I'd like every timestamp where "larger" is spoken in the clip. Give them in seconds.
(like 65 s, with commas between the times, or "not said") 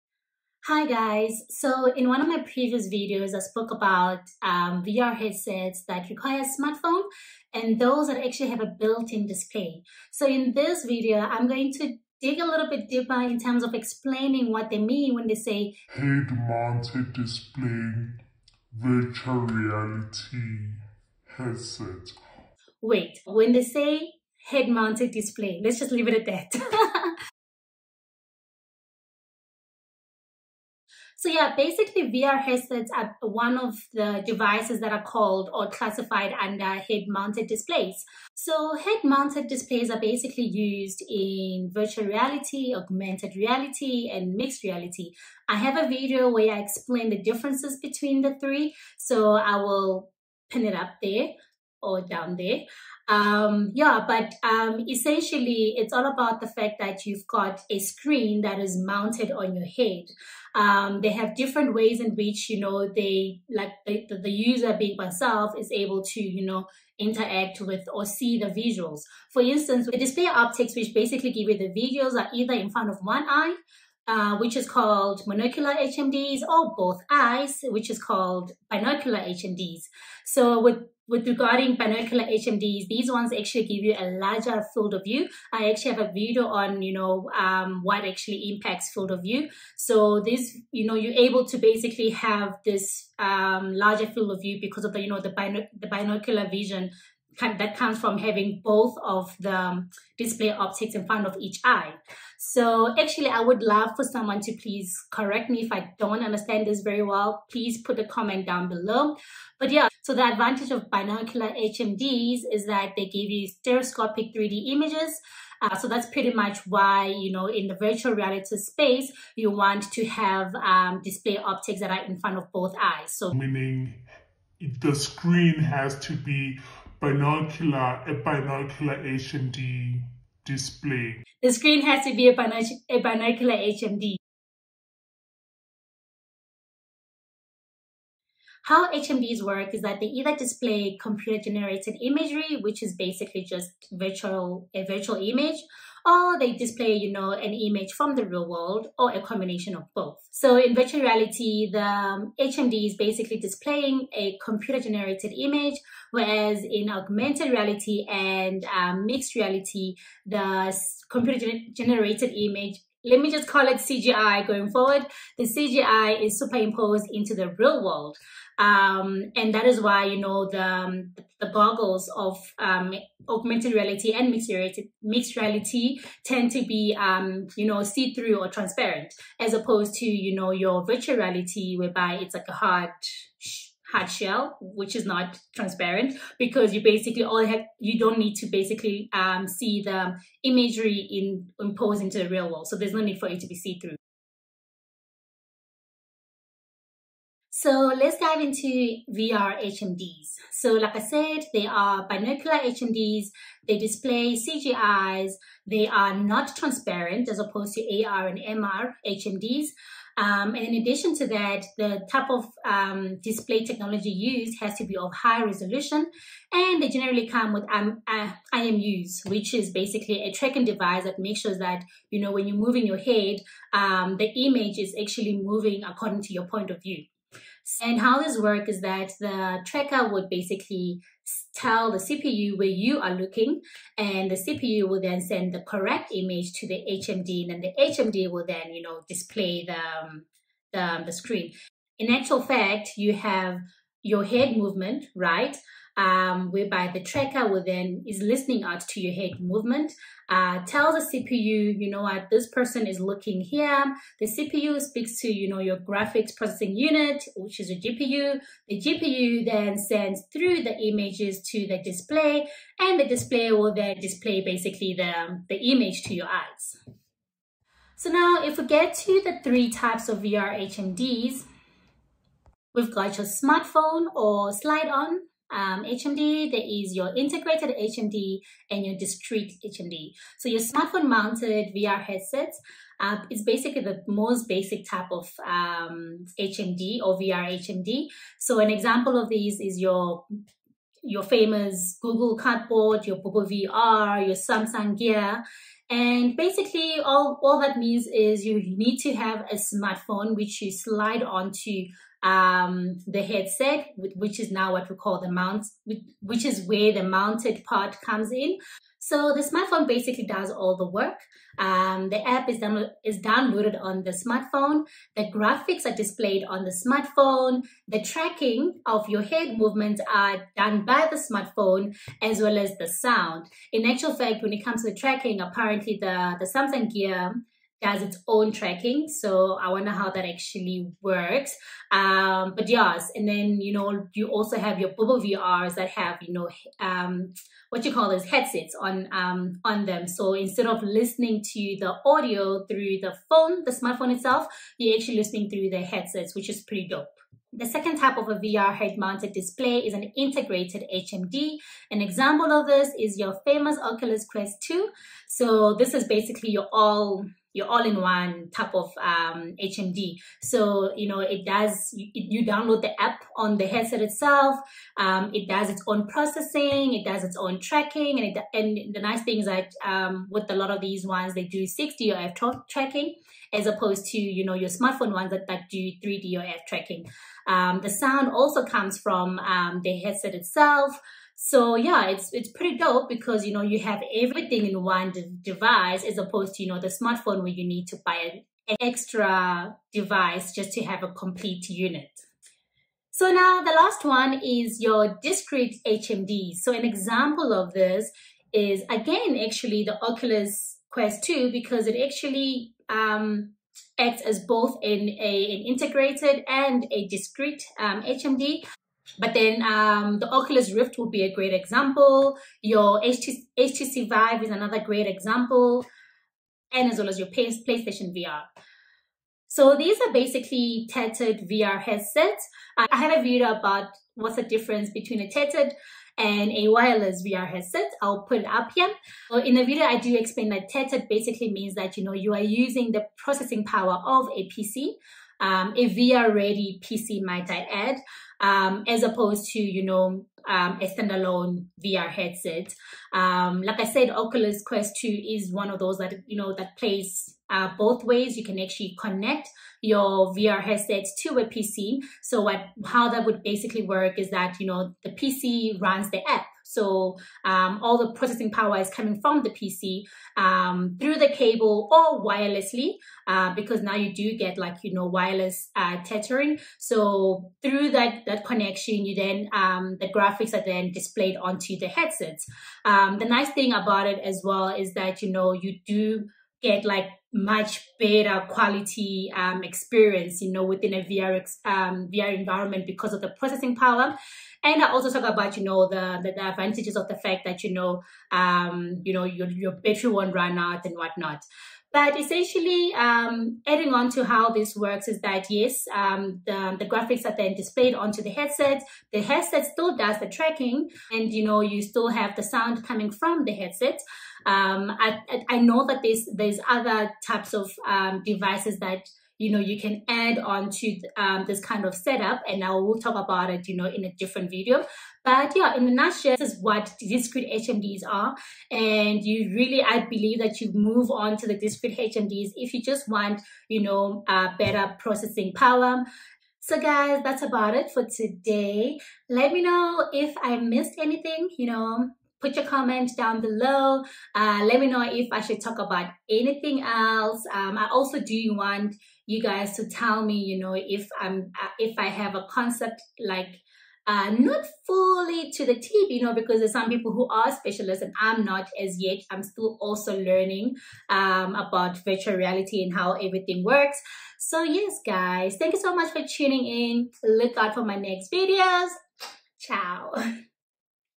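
84 s, 93 s.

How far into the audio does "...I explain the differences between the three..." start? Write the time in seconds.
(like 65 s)
46 s.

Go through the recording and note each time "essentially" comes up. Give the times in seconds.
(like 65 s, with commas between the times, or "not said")
54 s, 492 s.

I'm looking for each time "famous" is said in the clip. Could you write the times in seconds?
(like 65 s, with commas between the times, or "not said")
291 s, 353 s.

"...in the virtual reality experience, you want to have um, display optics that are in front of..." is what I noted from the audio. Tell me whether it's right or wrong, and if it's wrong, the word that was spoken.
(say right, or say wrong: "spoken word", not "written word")
wrong: "space", not "experience".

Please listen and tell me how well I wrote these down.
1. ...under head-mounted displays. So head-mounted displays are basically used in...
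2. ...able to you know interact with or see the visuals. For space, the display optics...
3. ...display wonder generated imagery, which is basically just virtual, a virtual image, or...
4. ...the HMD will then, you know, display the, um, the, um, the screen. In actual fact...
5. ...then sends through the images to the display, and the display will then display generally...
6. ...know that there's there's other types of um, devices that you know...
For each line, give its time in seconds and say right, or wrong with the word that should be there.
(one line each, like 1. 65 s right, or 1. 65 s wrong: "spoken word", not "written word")
1. 36 s right
2. 65 s wrong: "instance", not "space"
3. 140 s wrong: "computer", not "wonder"
4. 237 s right
5. 259 s wrong: "basically", not "generally"
6. 505 s right.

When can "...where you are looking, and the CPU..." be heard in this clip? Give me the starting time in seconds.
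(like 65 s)
232 s.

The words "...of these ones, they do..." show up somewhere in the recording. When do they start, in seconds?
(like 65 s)
370 s.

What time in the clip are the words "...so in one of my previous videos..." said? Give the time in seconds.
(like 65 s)
1 s.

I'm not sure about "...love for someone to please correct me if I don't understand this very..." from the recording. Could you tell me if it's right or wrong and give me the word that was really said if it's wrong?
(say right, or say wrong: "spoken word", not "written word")
right.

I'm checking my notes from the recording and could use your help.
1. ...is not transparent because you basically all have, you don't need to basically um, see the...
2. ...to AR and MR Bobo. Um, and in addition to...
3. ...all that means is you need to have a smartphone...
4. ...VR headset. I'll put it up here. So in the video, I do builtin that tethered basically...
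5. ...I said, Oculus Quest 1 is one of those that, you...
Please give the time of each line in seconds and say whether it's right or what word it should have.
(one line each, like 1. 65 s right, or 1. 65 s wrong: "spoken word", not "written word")
1. 184 s right
2. 207 s wrong: "HMDs", not "Bobo"
3. 297 s right
4. 427 s wrong: "explain", not "builtin"
5. 443 s wrong: "2", not "1".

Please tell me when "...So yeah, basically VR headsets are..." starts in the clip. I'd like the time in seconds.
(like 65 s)
31 s.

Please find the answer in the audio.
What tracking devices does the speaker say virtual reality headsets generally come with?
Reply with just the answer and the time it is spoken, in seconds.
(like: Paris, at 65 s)
IMUs, at 218 s.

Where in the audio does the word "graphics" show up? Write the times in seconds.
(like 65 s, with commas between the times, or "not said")
255 s, 315 s, 470 s, 496 s.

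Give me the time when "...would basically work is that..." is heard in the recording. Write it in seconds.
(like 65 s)
453 s.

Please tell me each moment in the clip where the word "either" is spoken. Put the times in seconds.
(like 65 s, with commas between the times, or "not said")
72 s, 140 s.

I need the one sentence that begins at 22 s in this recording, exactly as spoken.
Wait, when they say head-mounted display, let's just leave it at that.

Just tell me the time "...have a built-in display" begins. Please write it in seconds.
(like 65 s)
8 s.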